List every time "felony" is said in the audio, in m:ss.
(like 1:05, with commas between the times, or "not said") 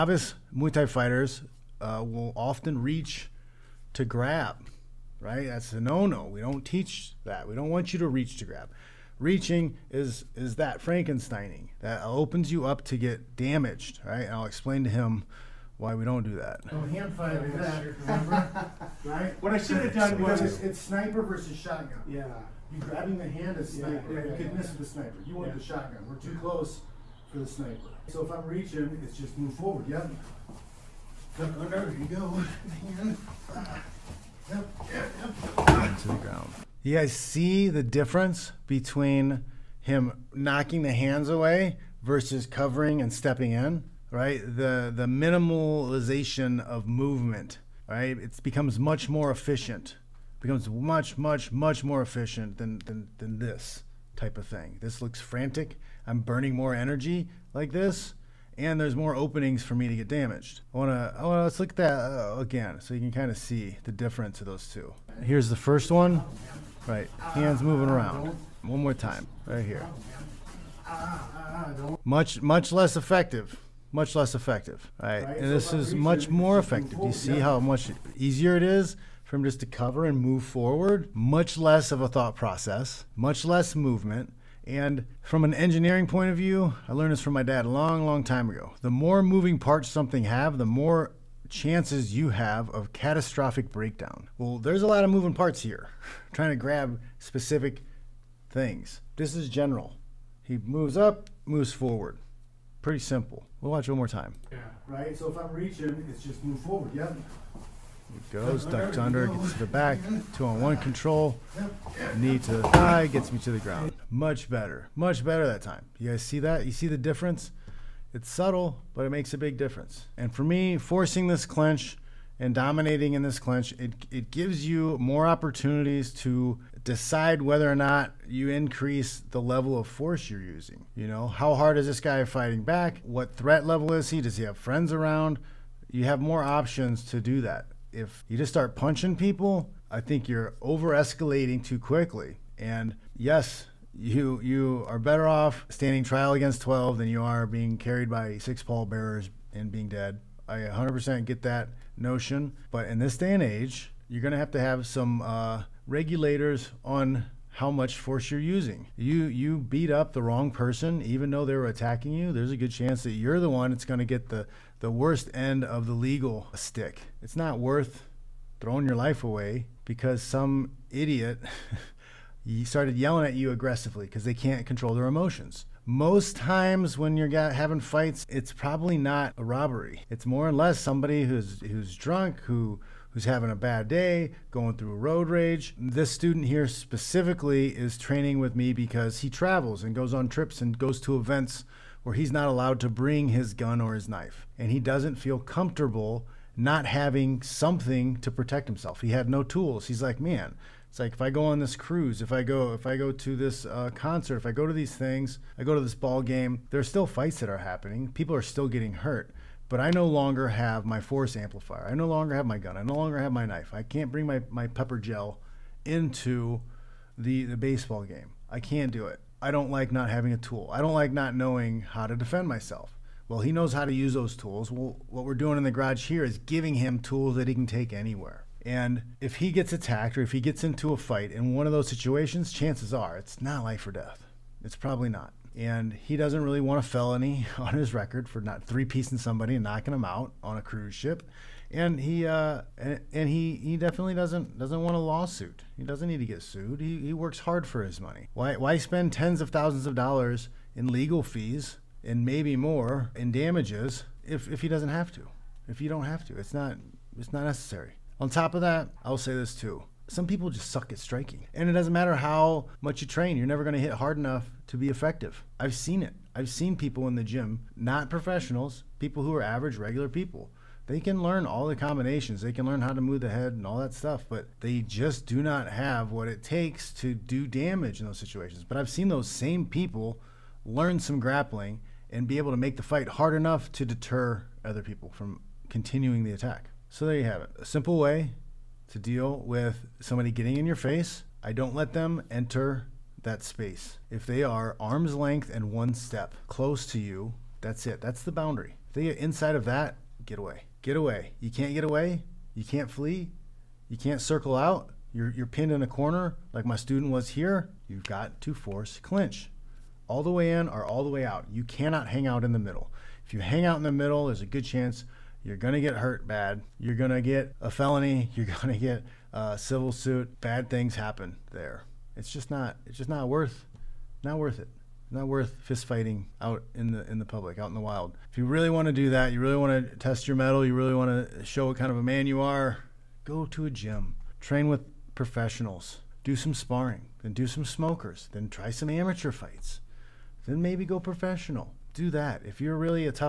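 3:56, 5:17.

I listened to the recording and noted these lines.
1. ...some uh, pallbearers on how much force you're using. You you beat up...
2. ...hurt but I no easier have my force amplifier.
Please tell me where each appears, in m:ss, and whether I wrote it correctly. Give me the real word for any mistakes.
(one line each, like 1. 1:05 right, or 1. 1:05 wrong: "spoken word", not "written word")
1. 2:34 wrong: "regulators", not "pallbearers"
2. 3:28 wrong: "longer", not "easier".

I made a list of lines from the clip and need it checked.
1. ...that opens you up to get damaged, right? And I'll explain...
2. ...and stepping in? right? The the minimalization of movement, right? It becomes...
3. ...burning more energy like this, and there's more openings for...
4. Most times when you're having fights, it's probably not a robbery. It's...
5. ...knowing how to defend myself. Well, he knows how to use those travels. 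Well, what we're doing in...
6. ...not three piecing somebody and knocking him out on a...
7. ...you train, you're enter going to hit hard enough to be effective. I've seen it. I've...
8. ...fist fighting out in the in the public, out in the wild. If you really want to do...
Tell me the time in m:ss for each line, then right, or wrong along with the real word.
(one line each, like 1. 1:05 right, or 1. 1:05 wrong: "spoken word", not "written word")
1. 0:11 right
2. 0:43 right
3. 0:56 right
4. 2:55 right
5. 3:41 wrong: "tools", not "travels"
6. 3:58 right
7. 4:22 wrong: "never", not "enter"
8. 5:25 right.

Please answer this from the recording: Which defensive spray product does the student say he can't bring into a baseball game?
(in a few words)
pepper gel.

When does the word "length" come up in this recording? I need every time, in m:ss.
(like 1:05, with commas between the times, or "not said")
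4:55.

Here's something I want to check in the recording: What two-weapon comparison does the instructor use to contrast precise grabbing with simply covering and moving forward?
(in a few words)
sniper versus shotgun.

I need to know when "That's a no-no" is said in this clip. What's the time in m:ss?
0:05.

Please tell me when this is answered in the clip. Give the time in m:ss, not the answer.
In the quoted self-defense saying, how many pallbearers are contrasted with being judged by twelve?
2:28.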